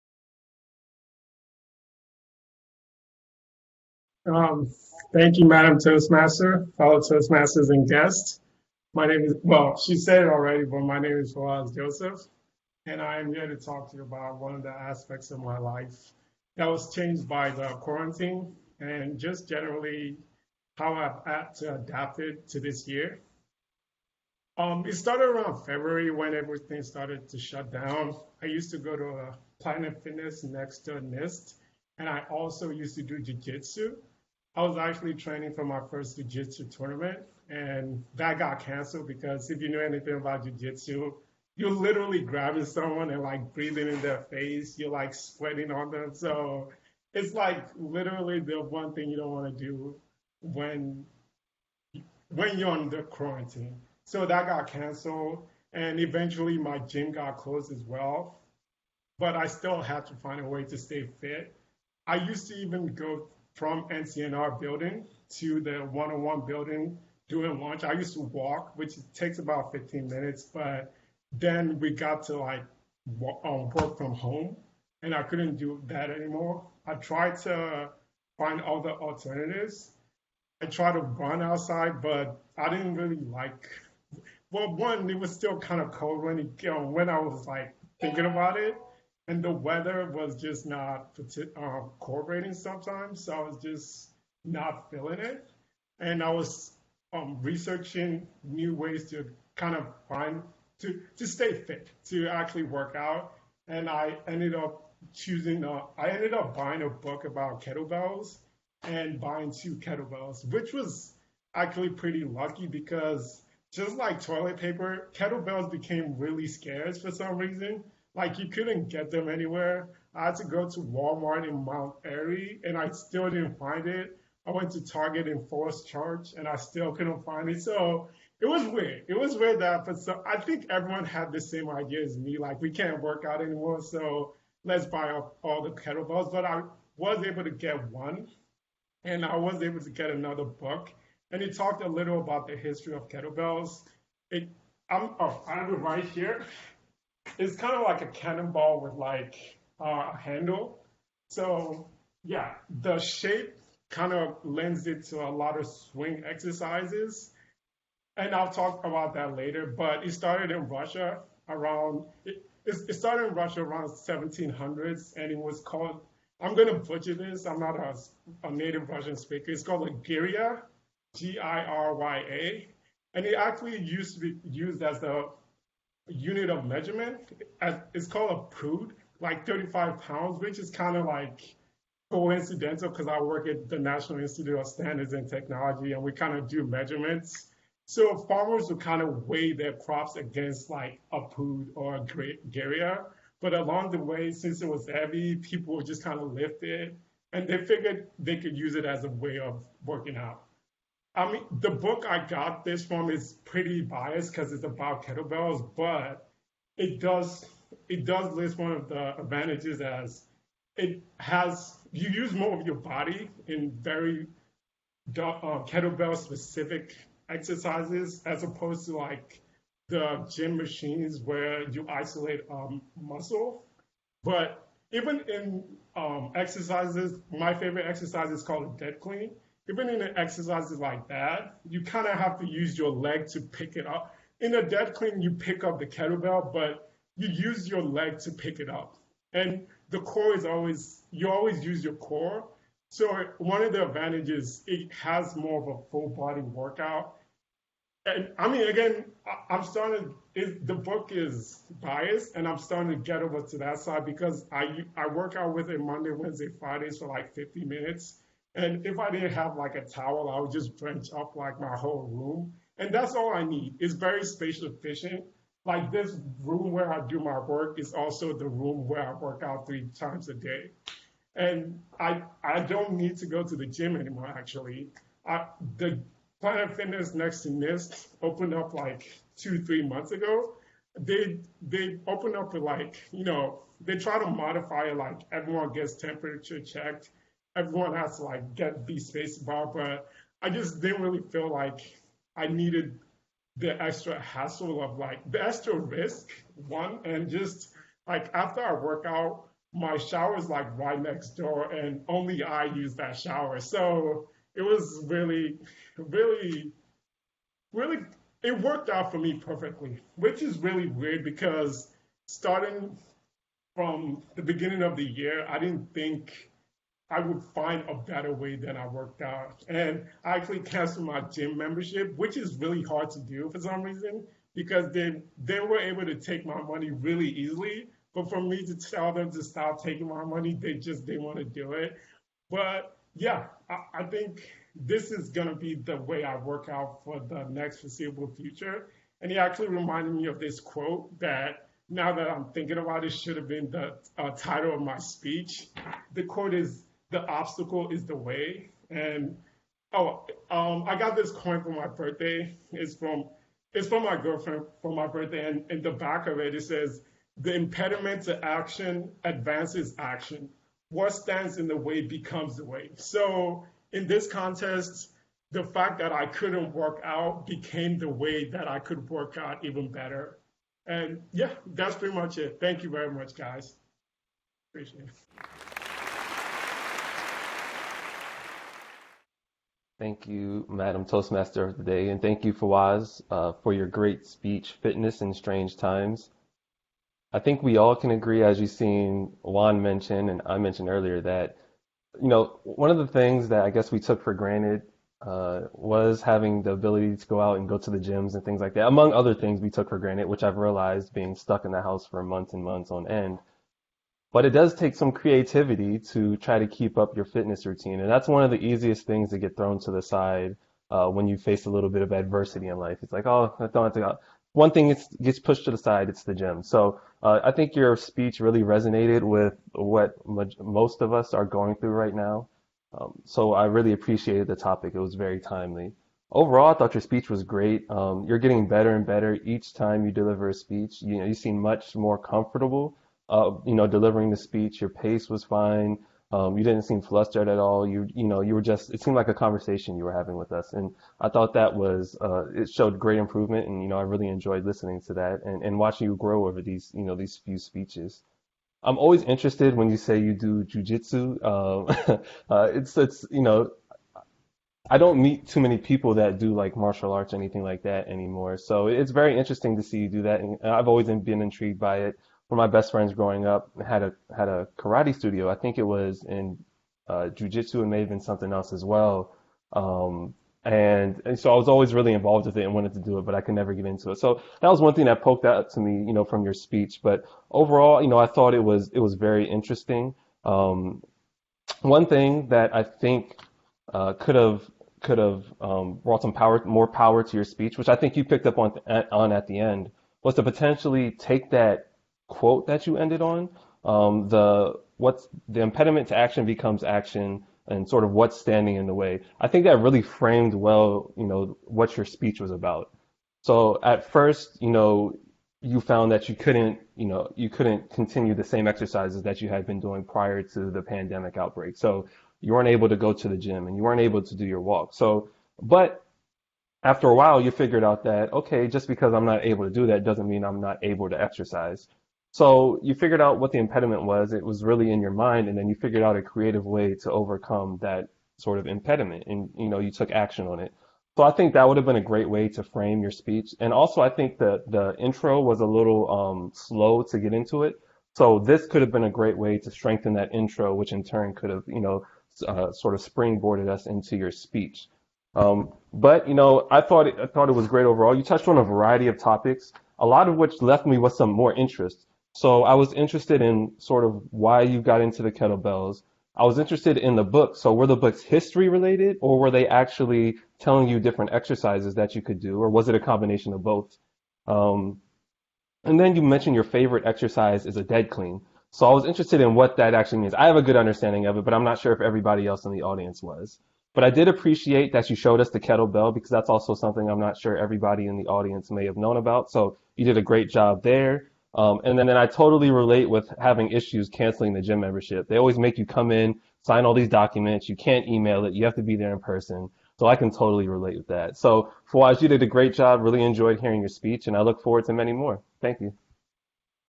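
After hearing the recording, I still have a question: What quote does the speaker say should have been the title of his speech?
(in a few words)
The obstacle is the way.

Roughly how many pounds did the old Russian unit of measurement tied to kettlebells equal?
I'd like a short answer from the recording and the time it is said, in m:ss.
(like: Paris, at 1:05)
35 pounds, at 2:59.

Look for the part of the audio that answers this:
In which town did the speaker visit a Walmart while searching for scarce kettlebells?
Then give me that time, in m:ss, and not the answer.
2:01.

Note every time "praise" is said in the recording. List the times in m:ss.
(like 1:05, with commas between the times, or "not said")
not said.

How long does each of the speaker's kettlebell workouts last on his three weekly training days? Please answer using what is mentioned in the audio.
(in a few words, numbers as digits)
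50 minutes.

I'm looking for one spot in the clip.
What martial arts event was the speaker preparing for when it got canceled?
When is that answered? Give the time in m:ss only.
0:35.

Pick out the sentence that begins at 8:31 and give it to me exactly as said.
So you weren't able to go to the gym and you weren't able to do your walk.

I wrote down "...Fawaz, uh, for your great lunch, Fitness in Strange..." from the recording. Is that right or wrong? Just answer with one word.
wrong.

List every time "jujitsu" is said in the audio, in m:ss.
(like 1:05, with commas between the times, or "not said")
7:30, 7:47.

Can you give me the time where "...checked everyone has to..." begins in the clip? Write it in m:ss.
4:46.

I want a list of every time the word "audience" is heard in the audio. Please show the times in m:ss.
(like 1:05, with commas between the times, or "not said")
9:32, 9:38.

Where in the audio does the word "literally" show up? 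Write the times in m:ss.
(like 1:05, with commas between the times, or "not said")
0:41, 0:47.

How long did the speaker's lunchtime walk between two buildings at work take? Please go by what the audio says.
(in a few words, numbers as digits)
15 minutes.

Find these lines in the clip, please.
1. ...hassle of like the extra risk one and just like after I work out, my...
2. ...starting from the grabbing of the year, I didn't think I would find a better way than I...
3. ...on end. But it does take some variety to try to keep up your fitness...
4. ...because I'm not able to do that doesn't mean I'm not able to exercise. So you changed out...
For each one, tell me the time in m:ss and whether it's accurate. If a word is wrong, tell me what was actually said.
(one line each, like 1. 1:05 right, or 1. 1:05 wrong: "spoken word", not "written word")
1. 4:54 right
2. 5:12 wrong: "beginning", not "grabbing"
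3. 6:42 wrong: "creativity", not "variety"
4. 8:38 wrong: "figured", not "changed".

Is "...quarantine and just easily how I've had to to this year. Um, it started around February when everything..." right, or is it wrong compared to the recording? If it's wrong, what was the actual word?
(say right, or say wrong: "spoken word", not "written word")
wrong: "generally", not "easily".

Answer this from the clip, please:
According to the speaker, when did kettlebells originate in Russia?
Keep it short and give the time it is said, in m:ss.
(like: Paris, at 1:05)
1700s, at 2:43.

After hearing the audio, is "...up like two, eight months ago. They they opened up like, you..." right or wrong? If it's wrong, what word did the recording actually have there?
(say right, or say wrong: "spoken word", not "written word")
wrong: "three", not "eight".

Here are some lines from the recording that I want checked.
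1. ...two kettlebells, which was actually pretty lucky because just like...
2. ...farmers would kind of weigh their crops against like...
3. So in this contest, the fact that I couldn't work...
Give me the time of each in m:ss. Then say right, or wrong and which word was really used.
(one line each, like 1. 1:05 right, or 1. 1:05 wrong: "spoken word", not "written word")
1. 1:49 right
2. 3:08 right
3. 6:02 right.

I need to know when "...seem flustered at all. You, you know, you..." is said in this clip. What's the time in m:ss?
7:16.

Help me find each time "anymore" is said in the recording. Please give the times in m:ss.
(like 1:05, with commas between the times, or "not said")
1:16, 2:13, 4:33, 7:38.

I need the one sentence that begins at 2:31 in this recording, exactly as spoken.
So yeah, the shape kind of lends it to a lot of swing exercises.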